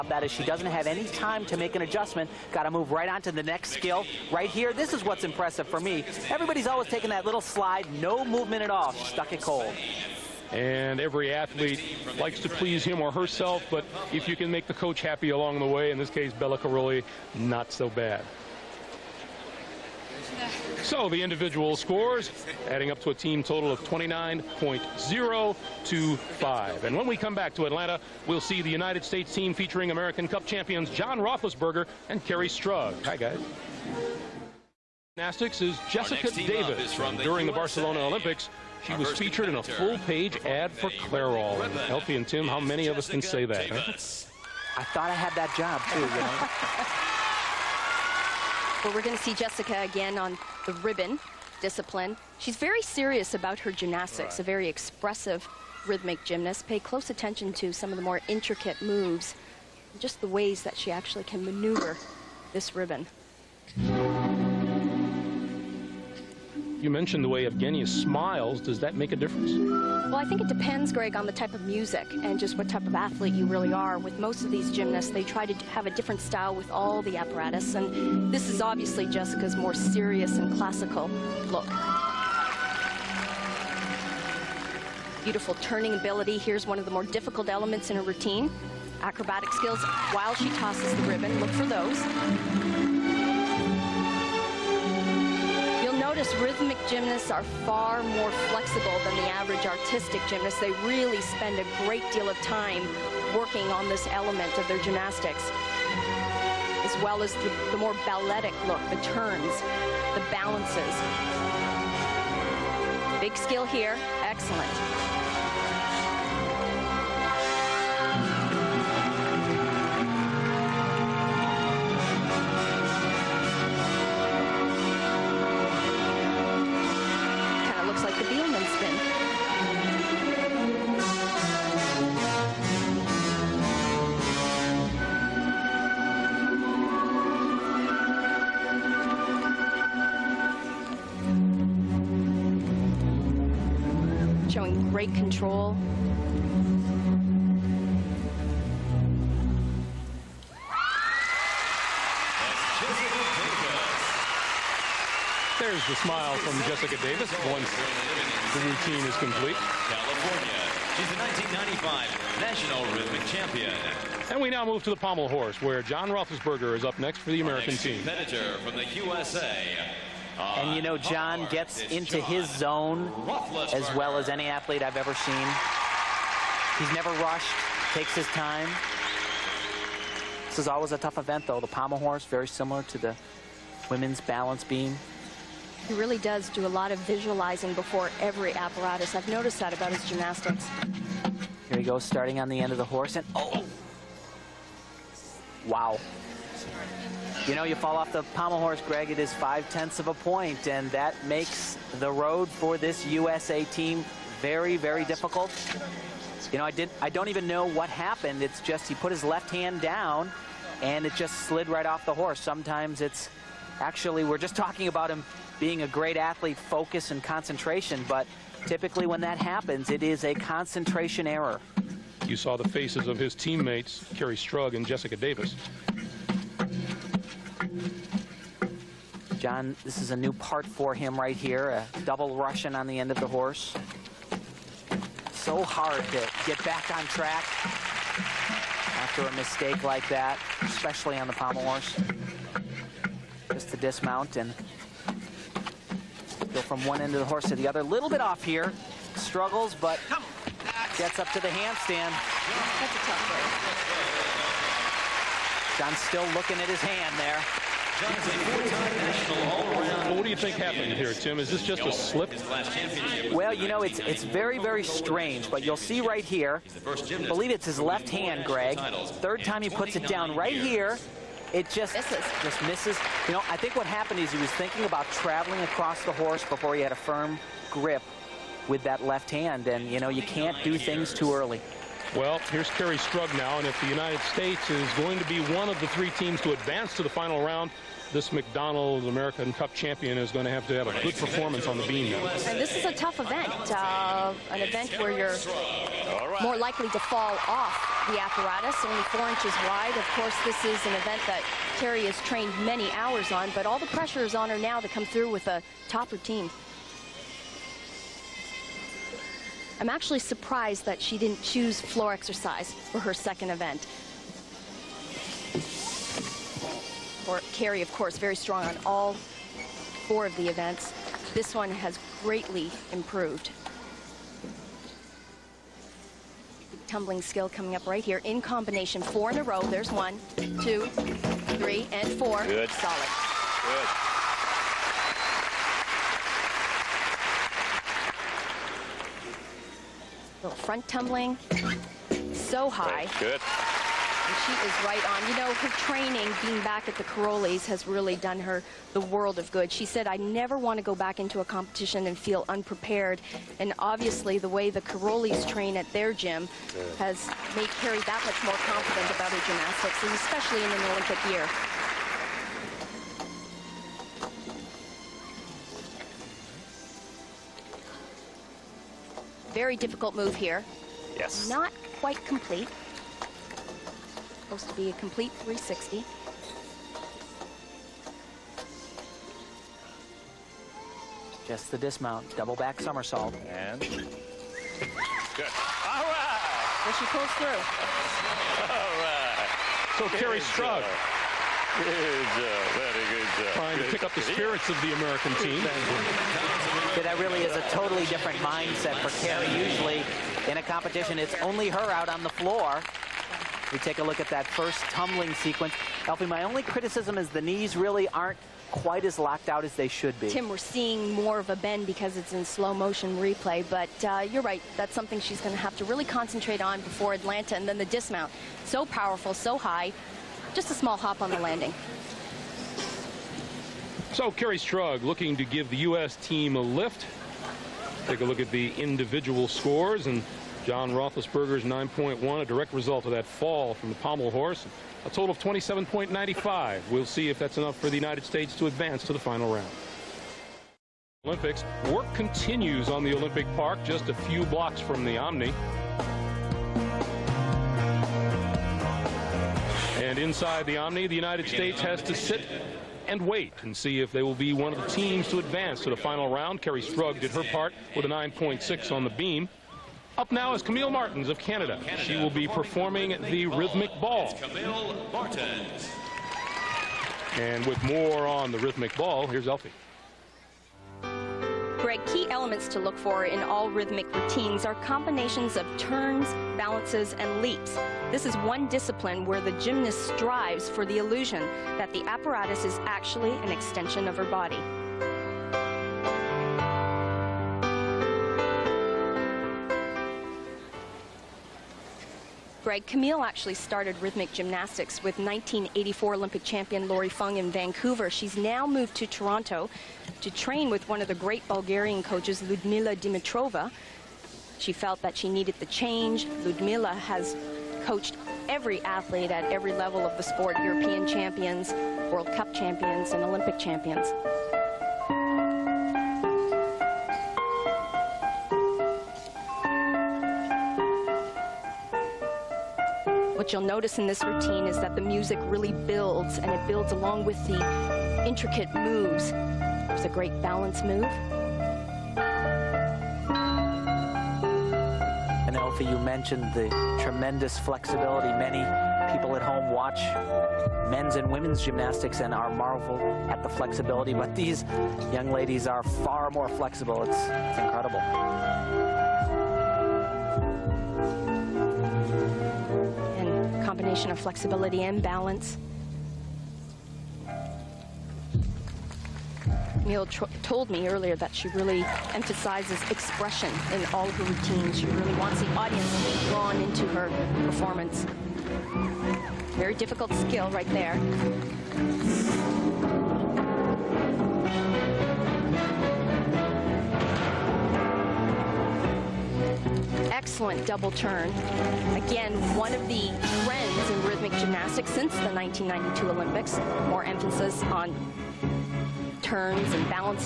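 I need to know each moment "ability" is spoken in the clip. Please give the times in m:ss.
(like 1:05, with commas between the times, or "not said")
1:25.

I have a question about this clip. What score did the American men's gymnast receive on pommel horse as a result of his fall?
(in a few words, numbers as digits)
9.1.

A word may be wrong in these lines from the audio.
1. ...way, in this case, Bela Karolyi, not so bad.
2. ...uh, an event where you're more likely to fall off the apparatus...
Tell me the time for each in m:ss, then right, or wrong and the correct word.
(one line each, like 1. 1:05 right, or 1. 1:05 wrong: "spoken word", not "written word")
1. 0:15 right
2. 4:53 right.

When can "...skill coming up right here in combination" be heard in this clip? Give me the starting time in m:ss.
5:27.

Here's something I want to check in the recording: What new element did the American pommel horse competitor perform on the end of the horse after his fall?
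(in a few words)
double Russian.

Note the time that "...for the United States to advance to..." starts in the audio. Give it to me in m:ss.
7:17.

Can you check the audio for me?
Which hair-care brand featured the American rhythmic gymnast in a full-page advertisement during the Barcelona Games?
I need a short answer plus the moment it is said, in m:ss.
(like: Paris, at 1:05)
Clairol, at 0:40.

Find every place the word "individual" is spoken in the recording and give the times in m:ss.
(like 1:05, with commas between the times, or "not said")
0:21, 7:08.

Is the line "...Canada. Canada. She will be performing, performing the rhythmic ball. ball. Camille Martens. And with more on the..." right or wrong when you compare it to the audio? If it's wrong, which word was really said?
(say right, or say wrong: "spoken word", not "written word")
right.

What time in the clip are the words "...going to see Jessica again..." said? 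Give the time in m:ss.
0:49.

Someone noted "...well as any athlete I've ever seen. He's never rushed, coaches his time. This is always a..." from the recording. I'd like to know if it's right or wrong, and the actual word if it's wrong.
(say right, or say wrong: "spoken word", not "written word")
wrong: "takes", not "coaches".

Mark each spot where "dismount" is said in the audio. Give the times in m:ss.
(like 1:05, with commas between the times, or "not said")
4:03, 6:21, 6:57.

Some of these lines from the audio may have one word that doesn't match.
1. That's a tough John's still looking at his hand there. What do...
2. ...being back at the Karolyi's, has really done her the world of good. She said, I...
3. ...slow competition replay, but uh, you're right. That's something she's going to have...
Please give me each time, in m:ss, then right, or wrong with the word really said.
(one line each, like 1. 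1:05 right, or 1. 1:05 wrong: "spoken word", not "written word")
1. 4:12 right
2. 5:46 right
3. 6:52 wrong: "motion", not "competition".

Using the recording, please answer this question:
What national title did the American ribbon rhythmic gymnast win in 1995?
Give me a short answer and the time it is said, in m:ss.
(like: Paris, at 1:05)
National Rhythmic Champion, at 2:42.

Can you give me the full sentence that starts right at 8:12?
Greg, Camille actually started rhythmic gymnastics with 1984 Olympic champion Lori Fung in Vancouver.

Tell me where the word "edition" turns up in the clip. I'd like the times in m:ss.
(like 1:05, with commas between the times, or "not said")
not said.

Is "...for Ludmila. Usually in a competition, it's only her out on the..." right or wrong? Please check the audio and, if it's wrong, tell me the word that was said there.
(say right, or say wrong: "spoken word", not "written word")
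wrong: "Kerri", not "Ludmila".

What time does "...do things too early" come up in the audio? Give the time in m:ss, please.
4:40.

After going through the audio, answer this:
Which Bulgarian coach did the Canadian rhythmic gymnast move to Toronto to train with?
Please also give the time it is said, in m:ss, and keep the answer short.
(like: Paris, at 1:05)
Ludmila Dimitrova, at 8:22.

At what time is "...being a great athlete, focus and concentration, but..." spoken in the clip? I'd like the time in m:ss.
3:35.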